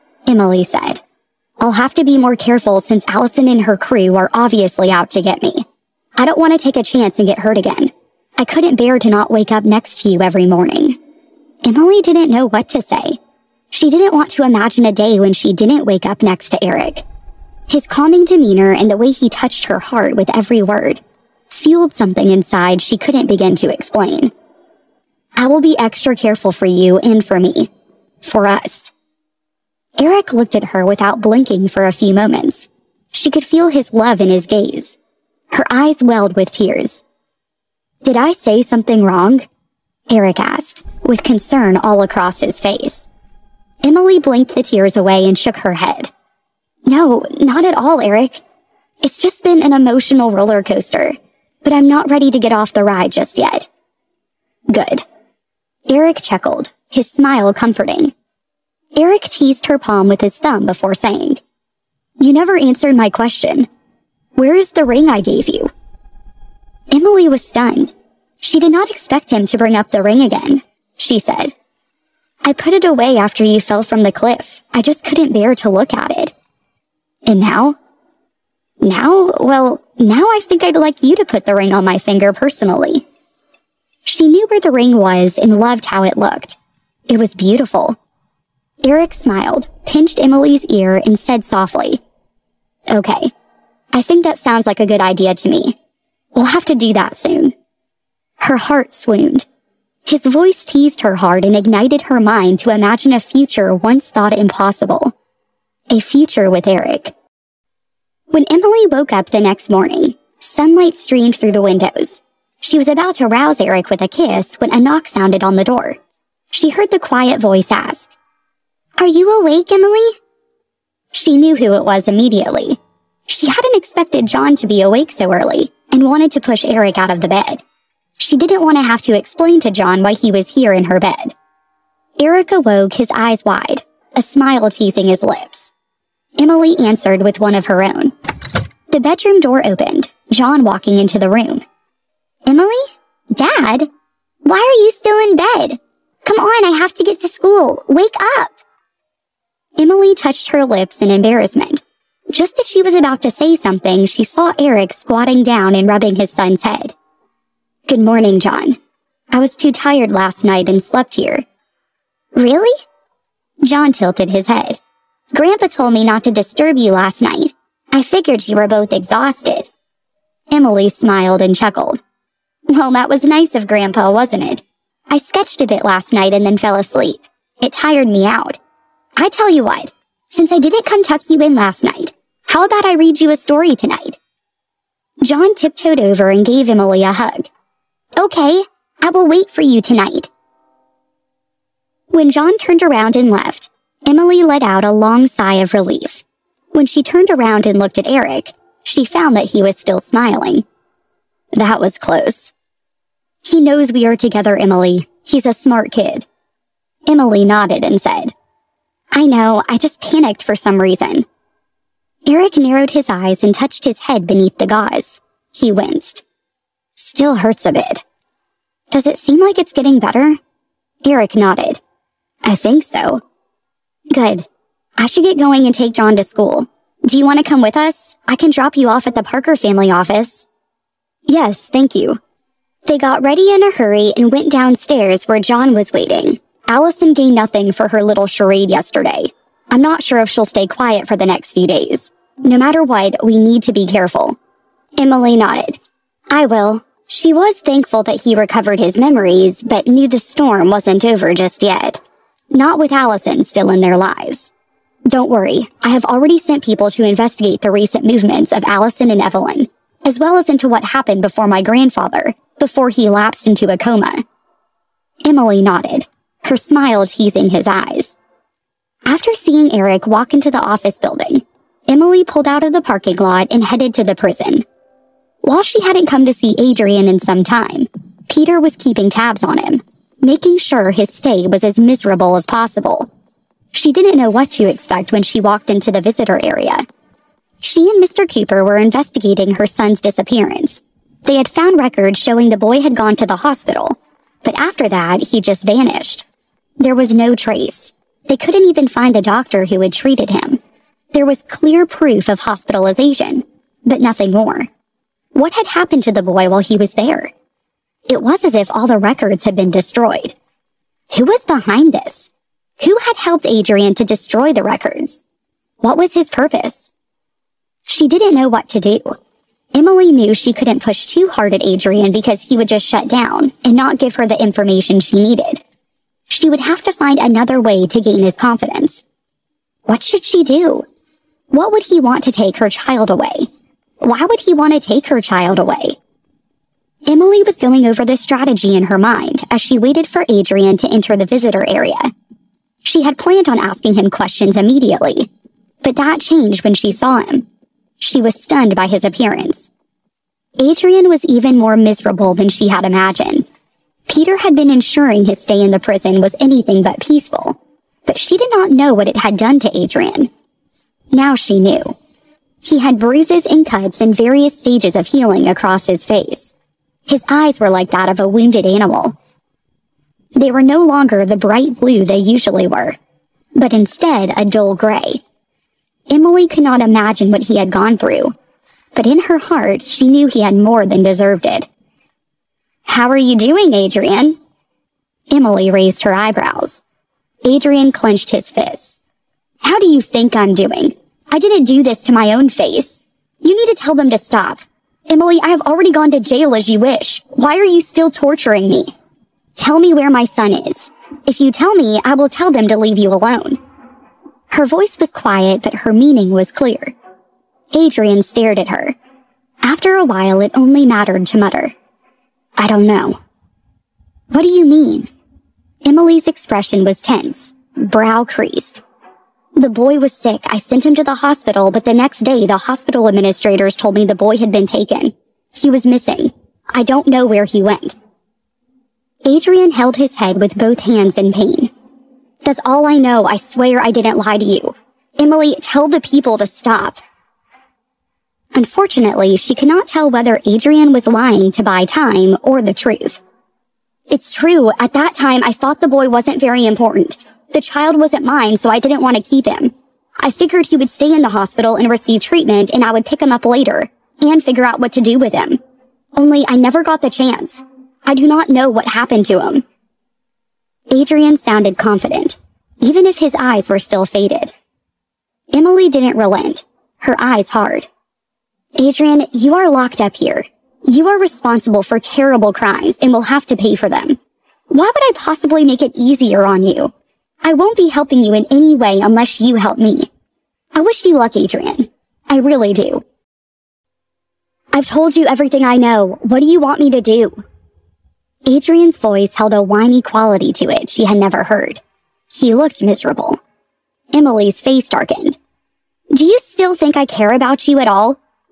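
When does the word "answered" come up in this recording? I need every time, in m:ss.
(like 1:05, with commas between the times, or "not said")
1:02, 2:16.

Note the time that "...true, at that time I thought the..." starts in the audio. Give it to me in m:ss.
7:24.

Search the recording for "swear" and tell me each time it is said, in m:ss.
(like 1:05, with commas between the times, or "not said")
7:13.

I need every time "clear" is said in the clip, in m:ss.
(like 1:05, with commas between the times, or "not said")
5:01, 6:46.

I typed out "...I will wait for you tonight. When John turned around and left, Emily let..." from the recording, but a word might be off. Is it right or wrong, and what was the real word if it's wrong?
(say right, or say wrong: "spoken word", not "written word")
right.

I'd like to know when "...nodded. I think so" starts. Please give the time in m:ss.
3:41.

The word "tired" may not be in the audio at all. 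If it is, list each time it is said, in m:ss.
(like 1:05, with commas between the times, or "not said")
2:39, 2:57.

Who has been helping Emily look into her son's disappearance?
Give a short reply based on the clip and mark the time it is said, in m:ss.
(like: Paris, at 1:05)
Mr. Cooper, at 4:48.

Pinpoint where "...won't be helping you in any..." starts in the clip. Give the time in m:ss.
7:57.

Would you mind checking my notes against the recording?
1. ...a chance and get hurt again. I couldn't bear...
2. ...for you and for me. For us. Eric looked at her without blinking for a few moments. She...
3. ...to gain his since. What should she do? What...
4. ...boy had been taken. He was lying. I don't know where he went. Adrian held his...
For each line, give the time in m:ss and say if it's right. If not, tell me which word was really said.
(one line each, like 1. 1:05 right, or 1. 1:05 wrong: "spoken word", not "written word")
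1. 0:06 right
2. 0:26 right
3. 5:27 wrong: "confidence", not "since"
4. 7:04 wrong: "missing", not "lying".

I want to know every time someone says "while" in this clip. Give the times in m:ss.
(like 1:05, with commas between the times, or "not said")
4:35, 5:06, 6:50.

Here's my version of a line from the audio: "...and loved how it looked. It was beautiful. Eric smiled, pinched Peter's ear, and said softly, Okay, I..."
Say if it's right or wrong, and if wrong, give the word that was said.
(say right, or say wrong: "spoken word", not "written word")
wrong: "Emily", not "Peter".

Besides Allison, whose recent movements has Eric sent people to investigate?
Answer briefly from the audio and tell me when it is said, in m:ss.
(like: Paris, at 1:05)
Evelyn, at 4:19.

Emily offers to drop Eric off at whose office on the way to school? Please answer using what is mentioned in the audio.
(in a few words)
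The Parker family office.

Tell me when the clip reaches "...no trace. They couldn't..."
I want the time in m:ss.
4:57.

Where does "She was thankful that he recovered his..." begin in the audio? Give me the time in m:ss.
4:07.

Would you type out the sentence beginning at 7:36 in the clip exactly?
Only I never got the chance.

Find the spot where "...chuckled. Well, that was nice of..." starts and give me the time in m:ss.
2:51.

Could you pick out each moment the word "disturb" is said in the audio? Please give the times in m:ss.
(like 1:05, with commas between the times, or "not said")
2:46.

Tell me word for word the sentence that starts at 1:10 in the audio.
She said, I put it away after you fell from the cliff.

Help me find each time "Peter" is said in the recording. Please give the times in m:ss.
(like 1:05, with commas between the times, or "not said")
4:38, 5:54.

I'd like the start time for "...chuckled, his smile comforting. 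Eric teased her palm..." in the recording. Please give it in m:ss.
0:56.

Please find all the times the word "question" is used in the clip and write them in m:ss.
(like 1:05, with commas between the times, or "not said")
1:03, 5:44.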